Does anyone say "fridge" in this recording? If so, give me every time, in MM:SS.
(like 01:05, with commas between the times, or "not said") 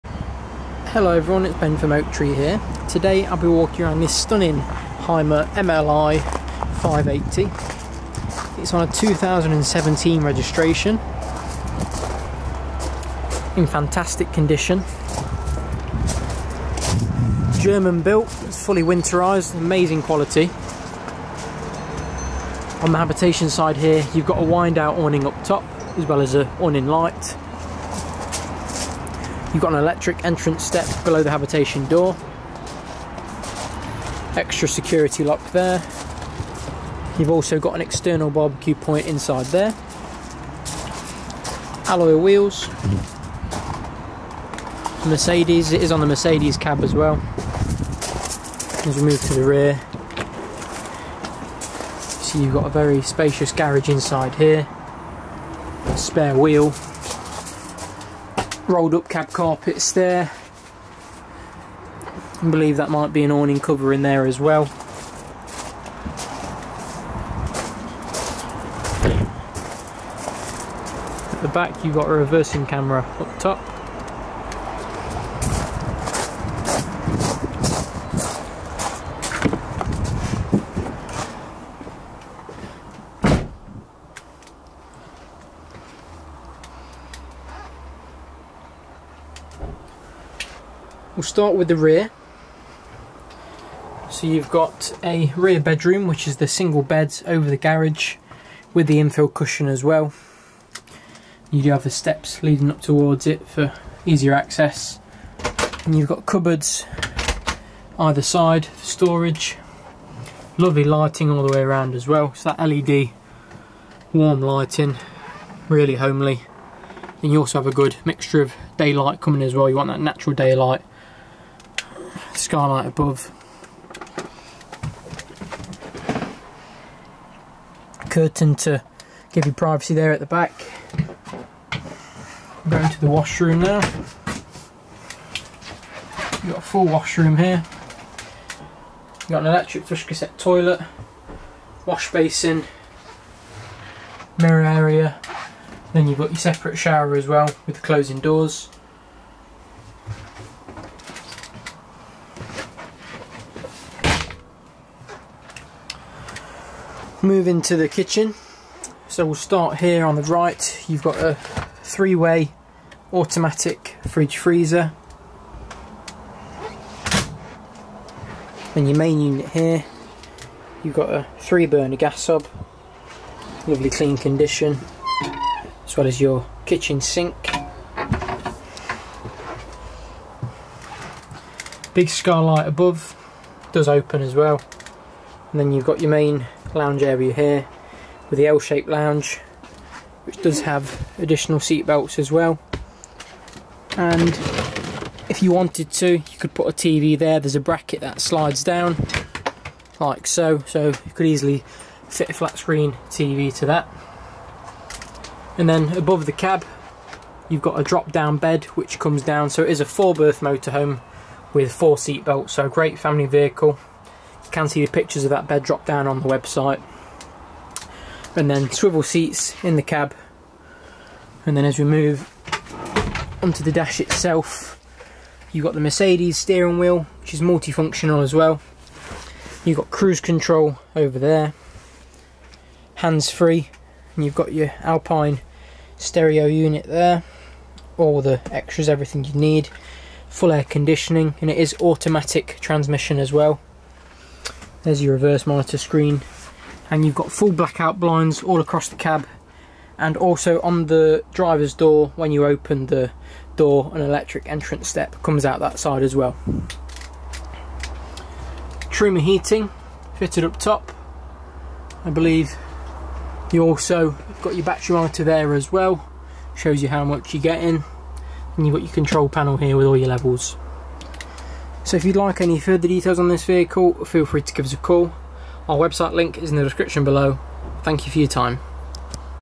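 02:44.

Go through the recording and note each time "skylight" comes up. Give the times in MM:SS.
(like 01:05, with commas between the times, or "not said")
02:02, 03:02.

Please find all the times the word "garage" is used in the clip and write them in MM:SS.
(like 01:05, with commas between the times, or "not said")
00:53, 01:37.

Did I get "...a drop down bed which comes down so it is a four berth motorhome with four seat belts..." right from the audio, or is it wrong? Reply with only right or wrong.
right.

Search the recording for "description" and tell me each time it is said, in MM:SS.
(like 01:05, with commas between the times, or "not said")
04:36.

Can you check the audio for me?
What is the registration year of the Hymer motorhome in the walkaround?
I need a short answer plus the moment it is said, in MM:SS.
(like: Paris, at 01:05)
2017, at 00:08.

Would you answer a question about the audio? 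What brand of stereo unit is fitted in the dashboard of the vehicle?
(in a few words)
Alpine.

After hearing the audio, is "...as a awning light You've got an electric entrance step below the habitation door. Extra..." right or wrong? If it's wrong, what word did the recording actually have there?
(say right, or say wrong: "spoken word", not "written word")
right.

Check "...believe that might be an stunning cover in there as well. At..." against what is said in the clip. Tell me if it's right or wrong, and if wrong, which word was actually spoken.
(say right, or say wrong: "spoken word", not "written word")
wrong: "awning", not "stunning".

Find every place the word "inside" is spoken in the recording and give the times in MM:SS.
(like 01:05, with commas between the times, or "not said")
00:39, 00:53.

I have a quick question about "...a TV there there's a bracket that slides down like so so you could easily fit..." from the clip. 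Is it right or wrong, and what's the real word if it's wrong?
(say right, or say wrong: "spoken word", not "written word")
right.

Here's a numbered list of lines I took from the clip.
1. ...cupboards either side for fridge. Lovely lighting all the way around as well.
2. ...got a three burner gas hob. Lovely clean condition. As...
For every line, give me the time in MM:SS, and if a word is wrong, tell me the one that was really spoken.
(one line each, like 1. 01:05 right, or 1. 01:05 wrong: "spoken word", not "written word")
1. 01:46 wrong: "storage", not "fridge"
2. 02:50 right.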